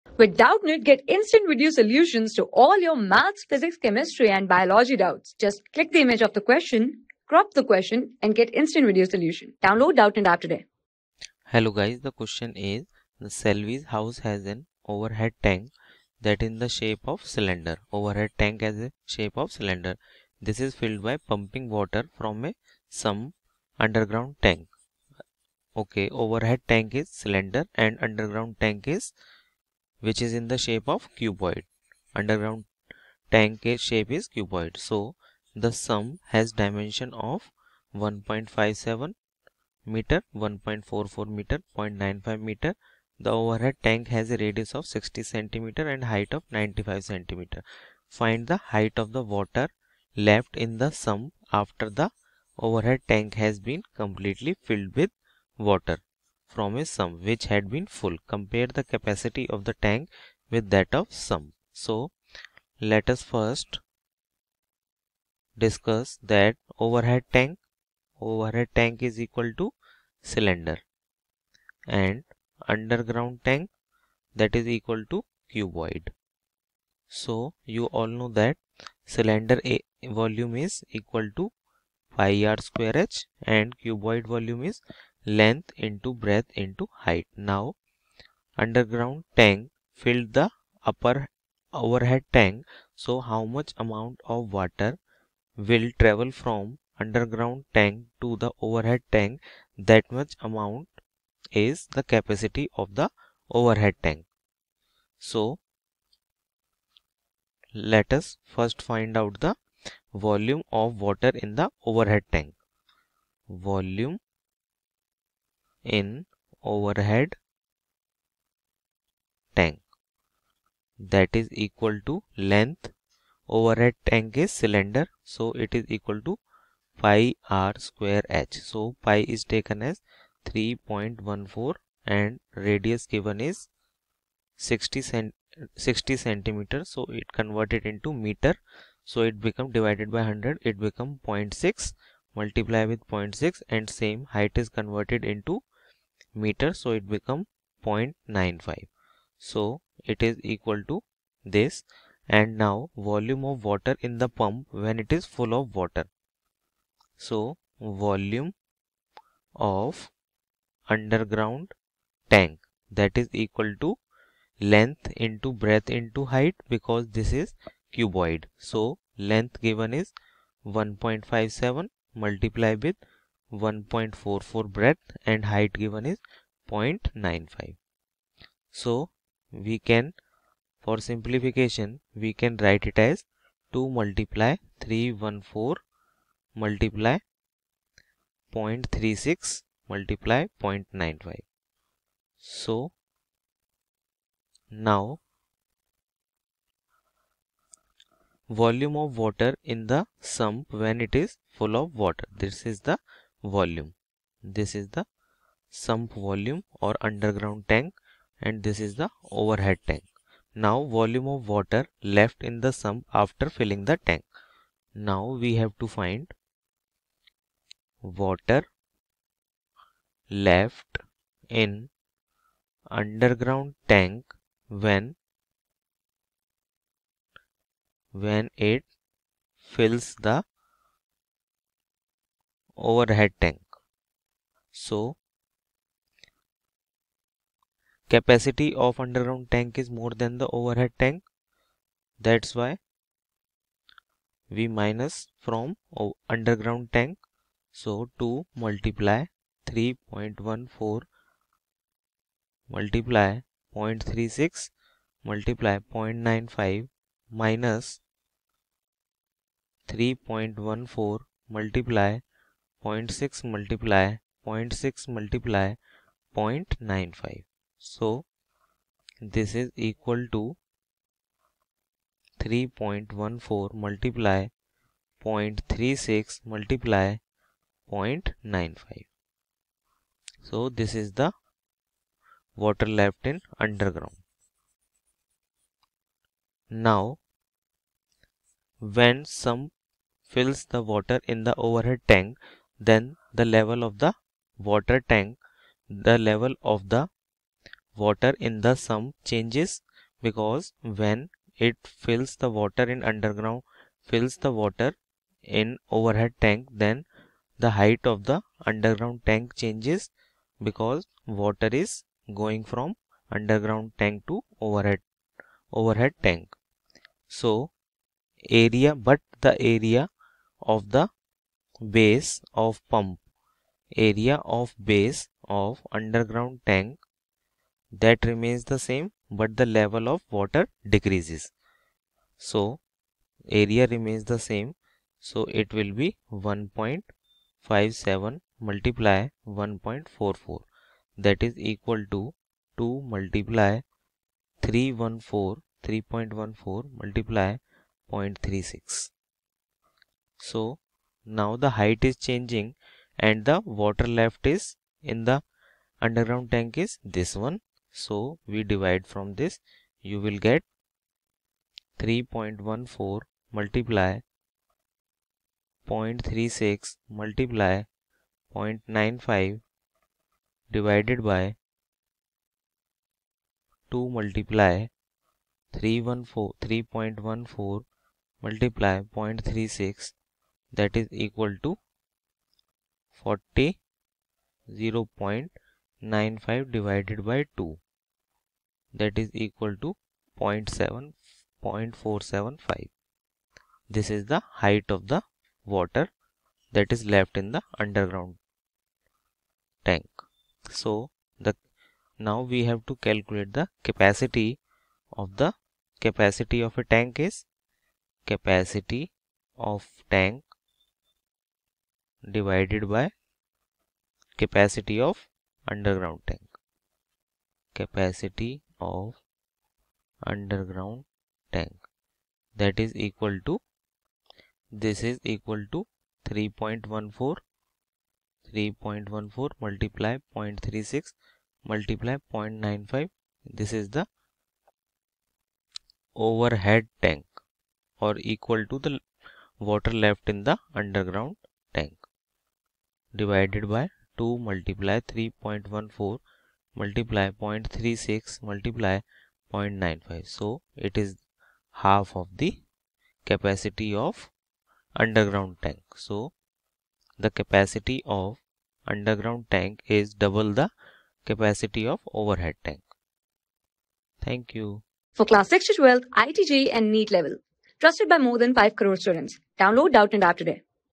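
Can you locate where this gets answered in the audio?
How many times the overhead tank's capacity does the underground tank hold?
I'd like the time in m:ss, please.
7:40.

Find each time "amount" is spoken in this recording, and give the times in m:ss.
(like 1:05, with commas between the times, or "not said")
1:33, 1:40.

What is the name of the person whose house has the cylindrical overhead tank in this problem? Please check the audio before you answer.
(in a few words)
Selvi.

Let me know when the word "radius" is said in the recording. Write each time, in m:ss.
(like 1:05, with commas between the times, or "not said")
0:44, 2:12.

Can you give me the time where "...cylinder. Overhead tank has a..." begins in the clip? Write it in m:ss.
0:17.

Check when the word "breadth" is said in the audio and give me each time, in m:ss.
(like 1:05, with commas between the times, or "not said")
1:26, 2:45, 2:54.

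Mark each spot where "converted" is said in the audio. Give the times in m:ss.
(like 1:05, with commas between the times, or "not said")
2:17, 2:24.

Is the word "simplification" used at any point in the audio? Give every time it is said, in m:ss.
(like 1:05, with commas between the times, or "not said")
3:01.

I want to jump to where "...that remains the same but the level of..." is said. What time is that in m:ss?
5:27.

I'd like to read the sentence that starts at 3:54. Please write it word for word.
So capacity of underground tank is more than the overhead tank.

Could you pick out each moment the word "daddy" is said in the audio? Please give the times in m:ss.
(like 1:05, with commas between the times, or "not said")
not said.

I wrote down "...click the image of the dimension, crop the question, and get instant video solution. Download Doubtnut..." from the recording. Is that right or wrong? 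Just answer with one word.
wrong.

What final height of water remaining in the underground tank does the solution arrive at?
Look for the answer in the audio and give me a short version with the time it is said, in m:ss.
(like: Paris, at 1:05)
0.475 meters, at 6:31.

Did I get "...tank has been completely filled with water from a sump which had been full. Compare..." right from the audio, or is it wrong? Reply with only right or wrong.
right.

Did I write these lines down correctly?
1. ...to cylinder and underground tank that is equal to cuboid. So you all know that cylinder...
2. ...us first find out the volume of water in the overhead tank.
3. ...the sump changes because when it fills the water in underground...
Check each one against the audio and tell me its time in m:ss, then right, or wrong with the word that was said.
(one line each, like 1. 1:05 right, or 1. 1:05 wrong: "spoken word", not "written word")
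1. 1:09 right
2. 1:48 right
3. 4:58 right.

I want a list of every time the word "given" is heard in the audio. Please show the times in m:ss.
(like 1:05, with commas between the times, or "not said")
2:13, 2:49, 2:55.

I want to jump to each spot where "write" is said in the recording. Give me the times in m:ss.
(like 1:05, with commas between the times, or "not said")
3:02.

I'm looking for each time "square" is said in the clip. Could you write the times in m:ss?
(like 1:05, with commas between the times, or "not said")
1:22, 2:07.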